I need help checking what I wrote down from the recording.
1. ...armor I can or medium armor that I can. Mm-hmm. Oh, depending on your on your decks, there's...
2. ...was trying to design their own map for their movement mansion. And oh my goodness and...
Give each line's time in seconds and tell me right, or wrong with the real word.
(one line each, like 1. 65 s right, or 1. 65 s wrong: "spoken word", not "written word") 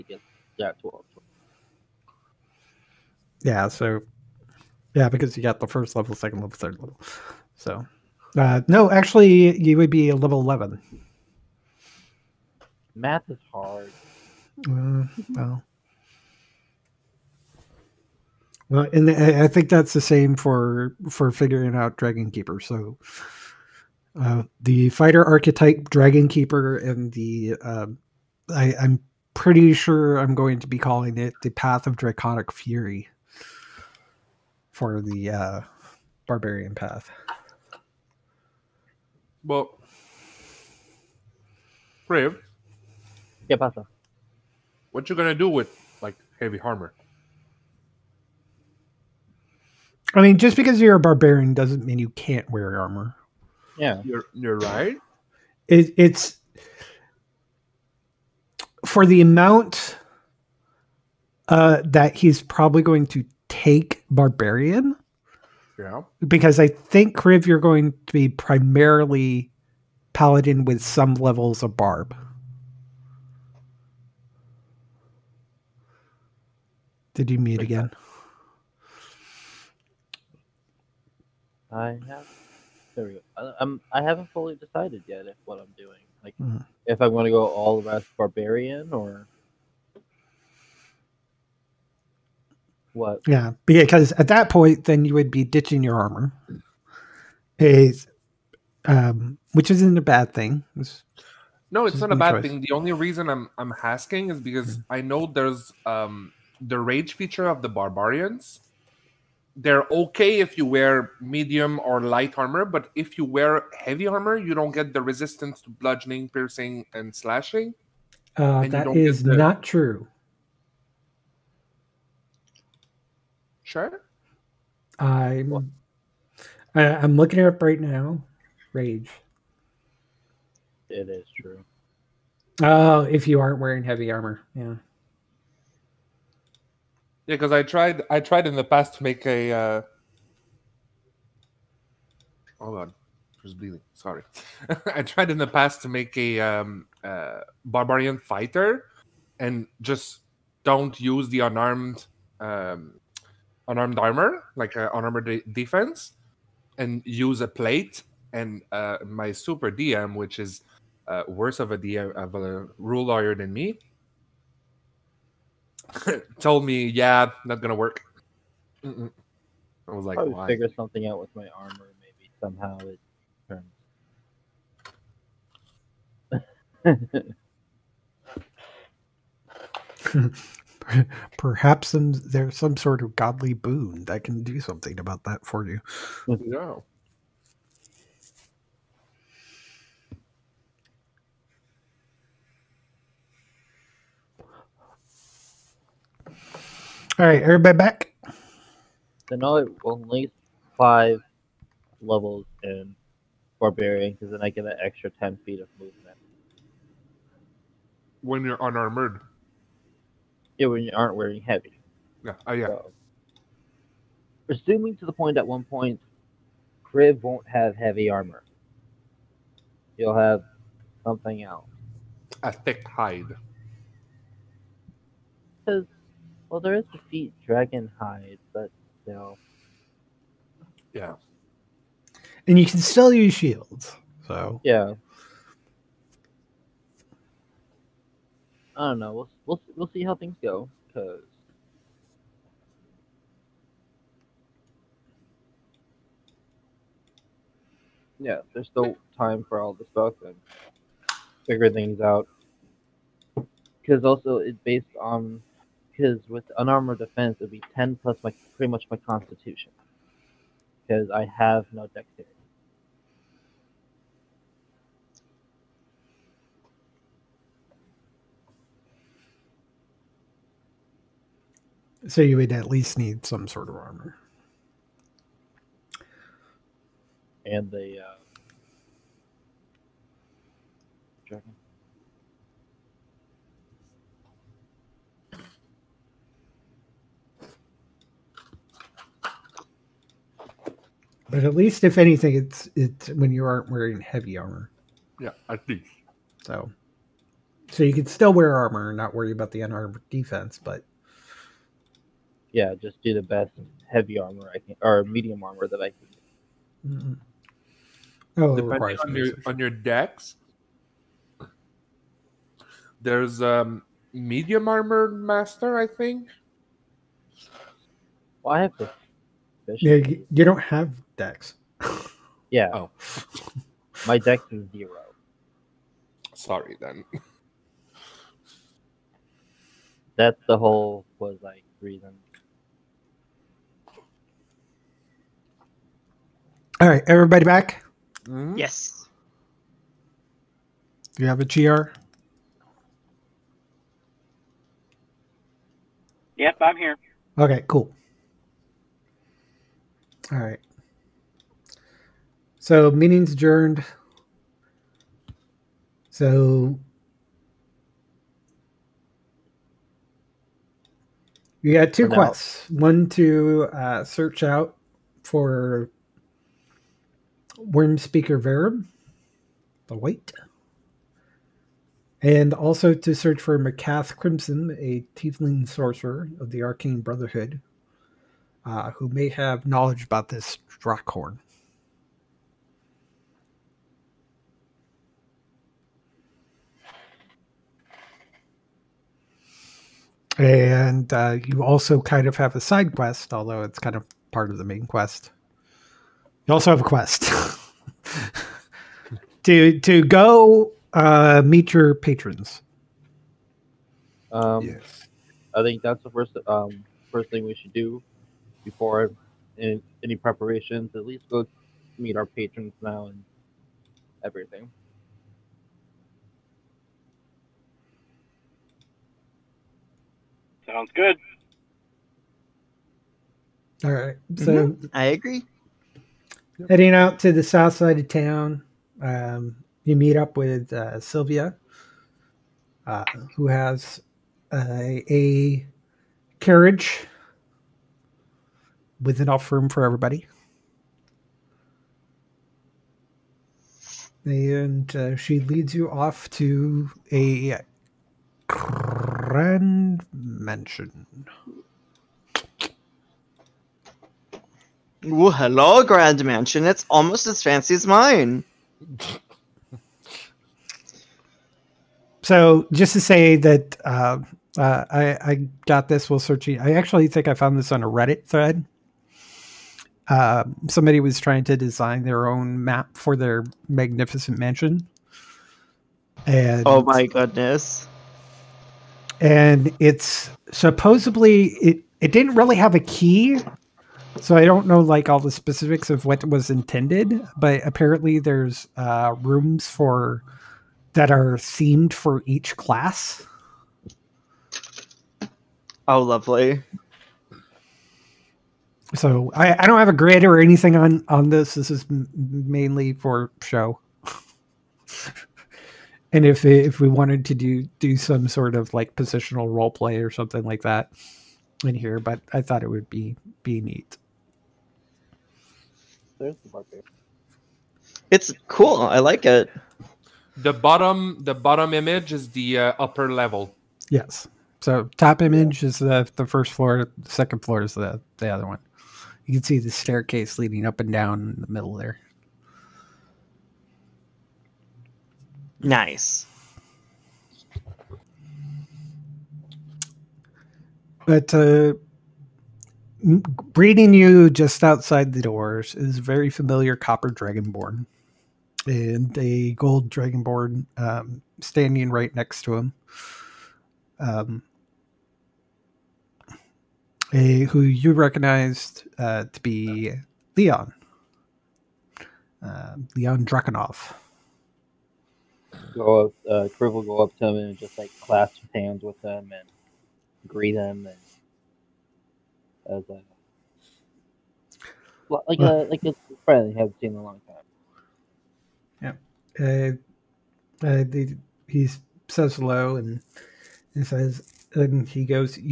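1. 304 s right
2. 470 s wrong: "magnificent", not "movement".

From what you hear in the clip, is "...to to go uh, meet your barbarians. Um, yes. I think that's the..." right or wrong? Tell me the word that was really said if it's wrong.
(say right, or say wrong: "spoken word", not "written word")
wrong: "patrons", not "barbarians".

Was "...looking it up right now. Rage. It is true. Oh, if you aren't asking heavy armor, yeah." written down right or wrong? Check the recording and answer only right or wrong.
wrong.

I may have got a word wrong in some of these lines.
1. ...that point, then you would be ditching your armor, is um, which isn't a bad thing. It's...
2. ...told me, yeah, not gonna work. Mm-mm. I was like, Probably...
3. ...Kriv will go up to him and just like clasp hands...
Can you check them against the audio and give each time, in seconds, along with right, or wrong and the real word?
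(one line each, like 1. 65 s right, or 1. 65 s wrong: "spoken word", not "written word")
1. 94 s right
2. 166 s right
3. 566 s right.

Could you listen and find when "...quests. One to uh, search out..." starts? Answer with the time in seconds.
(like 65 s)
362 s.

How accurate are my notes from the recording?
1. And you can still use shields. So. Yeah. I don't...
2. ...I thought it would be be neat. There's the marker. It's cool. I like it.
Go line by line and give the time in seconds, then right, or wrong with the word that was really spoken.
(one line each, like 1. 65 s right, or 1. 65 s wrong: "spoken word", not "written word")
1. 232 s right
2. 512 s right.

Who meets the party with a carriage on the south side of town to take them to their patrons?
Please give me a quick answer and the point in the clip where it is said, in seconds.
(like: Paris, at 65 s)
Sylvia, at 430 s.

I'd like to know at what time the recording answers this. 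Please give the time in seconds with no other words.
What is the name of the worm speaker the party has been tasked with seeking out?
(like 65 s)
368 s.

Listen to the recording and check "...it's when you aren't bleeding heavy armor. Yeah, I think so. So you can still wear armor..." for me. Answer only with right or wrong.
wrong.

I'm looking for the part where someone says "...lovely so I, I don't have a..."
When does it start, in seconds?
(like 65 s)
496 s.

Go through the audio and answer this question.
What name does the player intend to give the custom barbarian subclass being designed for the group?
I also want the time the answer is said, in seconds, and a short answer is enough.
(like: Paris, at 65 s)
Path of Draconic Fury, at 31 s.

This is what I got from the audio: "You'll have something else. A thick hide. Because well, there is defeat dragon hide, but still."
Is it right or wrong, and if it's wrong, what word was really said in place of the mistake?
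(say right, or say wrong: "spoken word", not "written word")
right.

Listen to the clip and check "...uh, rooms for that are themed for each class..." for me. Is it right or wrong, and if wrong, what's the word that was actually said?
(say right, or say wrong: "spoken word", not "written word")
right.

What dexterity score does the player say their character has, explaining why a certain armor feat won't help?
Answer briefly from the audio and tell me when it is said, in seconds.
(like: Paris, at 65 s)
0, at 324 s.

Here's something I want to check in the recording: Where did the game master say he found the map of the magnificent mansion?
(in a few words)
Reddit thread.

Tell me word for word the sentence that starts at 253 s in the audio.
Because also it's based on because with unarmored defense, it would be 10 plus my pretty much my constitution.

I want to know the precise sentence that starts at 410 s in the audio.
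At least go meet our patrons now and everything.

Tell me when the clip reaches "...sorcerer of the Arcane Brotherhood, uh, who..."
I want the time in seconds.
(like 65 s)
375 s.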